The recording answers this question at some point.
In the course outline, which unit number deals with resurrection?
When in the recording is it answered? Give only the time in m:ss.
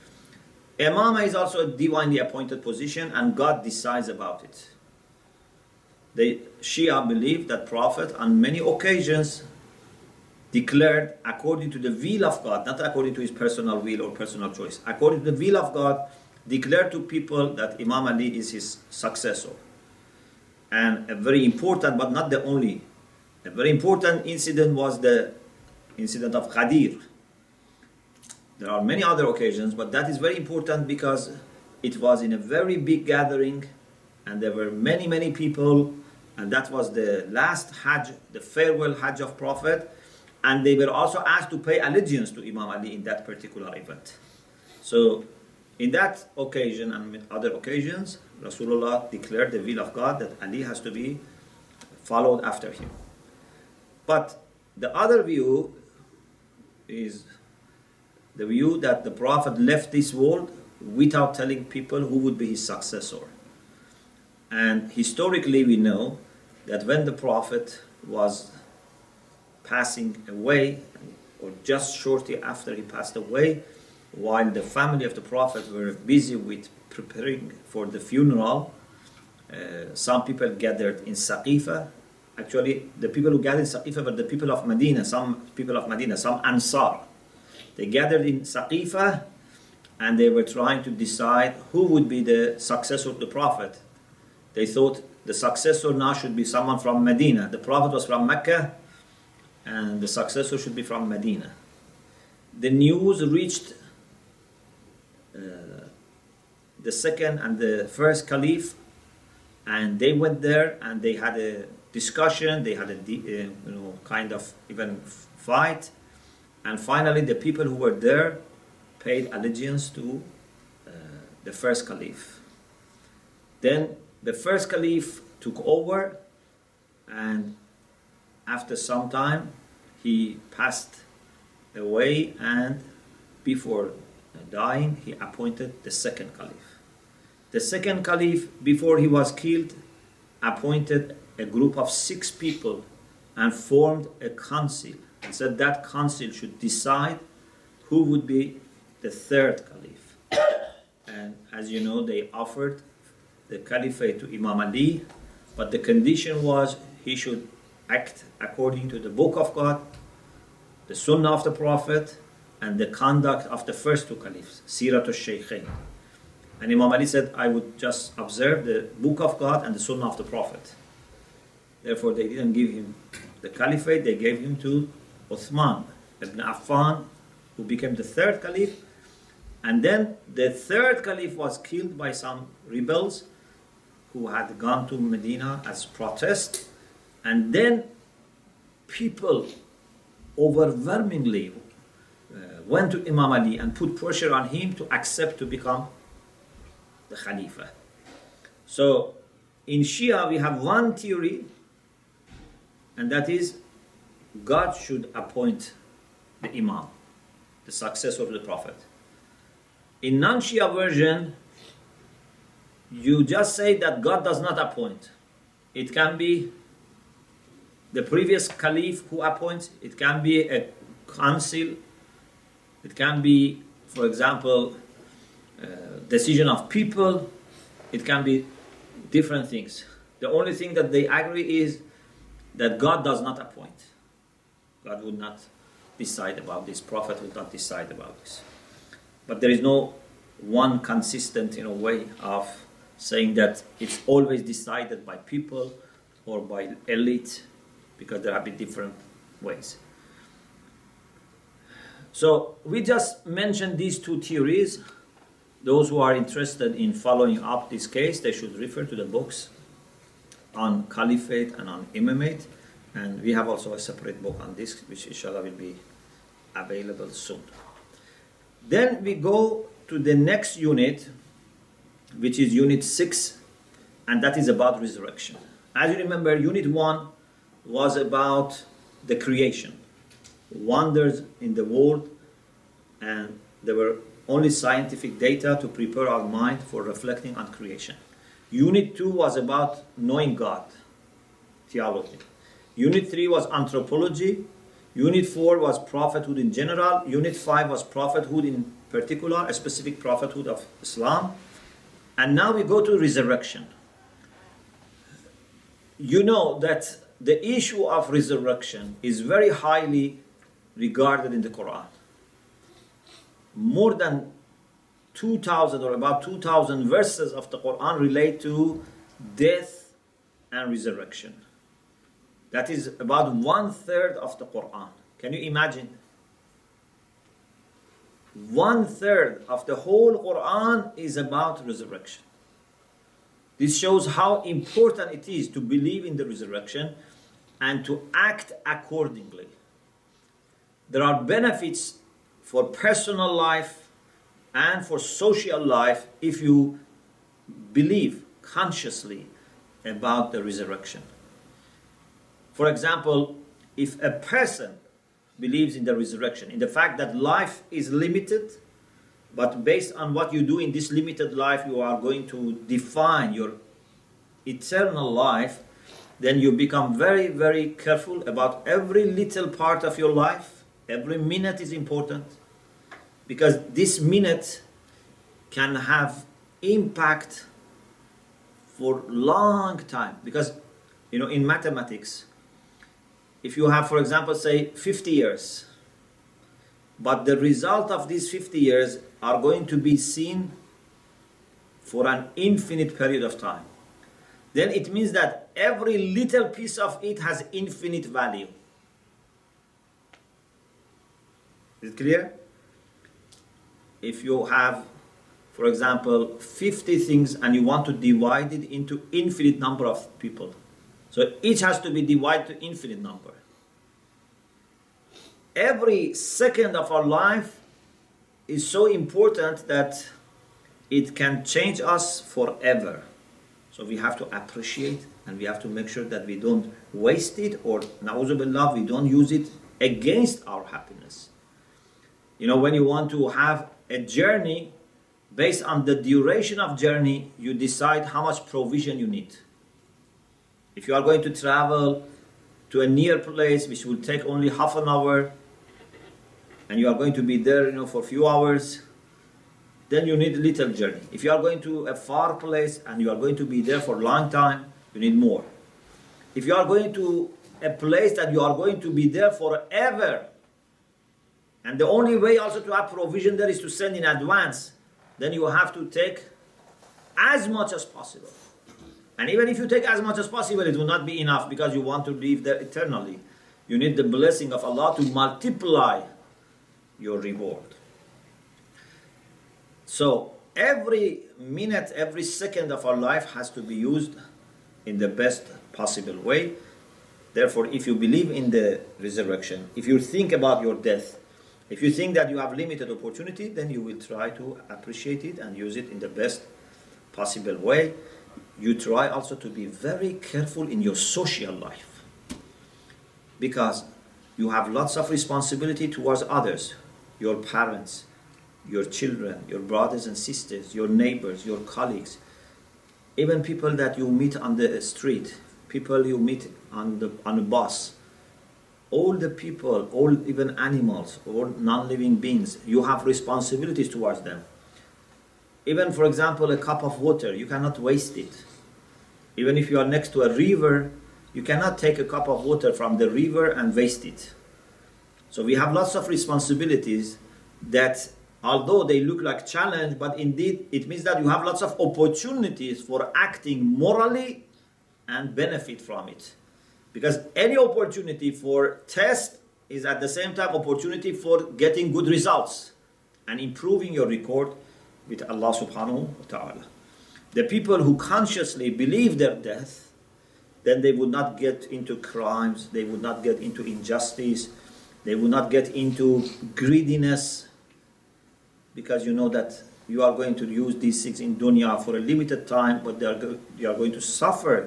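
4:32.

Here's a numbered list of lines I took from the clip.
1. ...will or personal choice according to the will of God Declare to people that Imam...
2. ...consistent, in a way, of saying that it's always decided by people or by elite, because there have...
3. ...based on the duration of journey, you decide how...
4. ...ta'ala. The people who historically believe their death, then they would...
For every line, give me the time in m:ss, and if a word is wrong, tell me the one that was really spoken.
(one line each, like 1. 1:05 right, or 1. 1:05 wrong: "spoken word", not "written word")
1. 0:13 right
2. 4:00 right
3. 7:15 right
4. 9:16 wrong: "consciously", not "historically".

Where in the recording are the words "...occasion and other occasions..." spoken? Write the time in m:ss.
0:46.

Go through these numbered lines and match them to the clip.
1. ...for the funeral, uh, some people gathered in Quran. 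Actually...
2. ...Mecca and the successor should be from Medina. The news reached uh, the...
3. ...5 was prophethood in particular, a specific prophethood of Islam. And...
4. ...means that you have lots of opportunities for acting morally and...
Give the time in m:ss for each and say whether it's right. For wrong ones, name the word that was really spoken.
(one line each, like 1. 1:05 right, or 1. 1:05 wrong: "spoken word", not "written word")
1. 1:17 wrong: "Saqifa", not "Quran"
2. 1:38 right
3. 4:57 right
4. 9:00 right.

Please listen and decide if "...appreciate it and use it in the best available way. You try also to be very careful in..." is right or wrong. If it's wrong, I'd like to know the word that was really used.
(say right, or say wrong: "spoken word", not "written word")
wrong: "possible", not "available".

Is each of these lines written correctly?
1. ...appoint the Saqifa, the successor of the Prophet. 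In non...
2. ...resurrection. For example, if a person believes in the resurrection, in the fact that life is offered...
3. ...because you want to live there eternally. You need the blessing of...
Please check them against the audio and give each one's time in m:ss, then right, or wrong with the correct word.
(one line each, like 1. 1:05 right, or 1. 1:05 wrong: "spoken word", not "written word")
1. 3:25 wrong: "Imam", not "Saqifa"
2. 5:50 wrong: "limited", not "offered"
3. 7:51 right.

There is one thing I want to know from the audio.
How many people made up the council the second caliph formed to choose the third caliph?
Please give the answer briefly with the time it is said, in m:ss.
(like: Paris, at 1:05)
6, at 2:21.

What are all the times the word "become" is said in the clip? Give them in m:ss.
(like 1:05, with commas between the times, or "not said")
3:15, 6:06.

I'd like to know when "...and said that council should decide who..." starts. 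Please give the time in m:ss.
2:25.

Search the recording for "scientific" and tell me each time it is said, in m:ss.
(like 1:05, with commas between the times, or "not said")
4:44.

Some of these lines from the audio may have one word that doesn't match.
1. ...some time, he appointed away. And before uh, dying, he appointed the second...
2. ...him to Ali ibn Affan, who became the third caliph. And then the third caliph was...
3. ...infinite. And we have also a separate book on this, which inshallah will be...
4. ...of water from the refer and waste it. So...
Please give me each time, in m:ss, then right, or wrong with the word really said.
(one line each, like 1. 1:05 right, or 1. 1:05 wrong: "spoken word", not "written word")
1. 2:08 wrong: "passed", not "appointed"
2. 2:54 wrong: "Uthman", not "Ali"
3. 4:21 wrong: "imamate", not "infinite"
4. 8:52 wrong: "river", not "refer".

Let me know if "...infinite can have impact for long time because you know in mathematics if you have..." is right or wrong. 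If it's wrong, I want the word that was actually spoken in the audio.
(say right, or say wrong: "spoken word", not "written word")
wrong: "minute", not "infinite".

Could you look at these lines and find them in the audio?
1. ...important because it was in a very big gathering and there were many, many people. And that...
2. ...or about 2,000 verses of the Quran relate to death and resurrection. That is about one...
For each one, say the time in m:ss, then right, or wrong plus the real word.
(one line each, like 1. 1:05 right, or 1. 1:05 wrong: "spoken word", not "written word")
1. 0:30 right
2. 5:15 right.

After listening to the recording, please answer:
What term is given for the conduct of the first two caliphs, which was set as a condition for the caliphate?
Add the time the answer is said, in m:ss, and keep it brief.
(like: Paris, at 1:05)
Sirat al-Shaykhain, at 2:44.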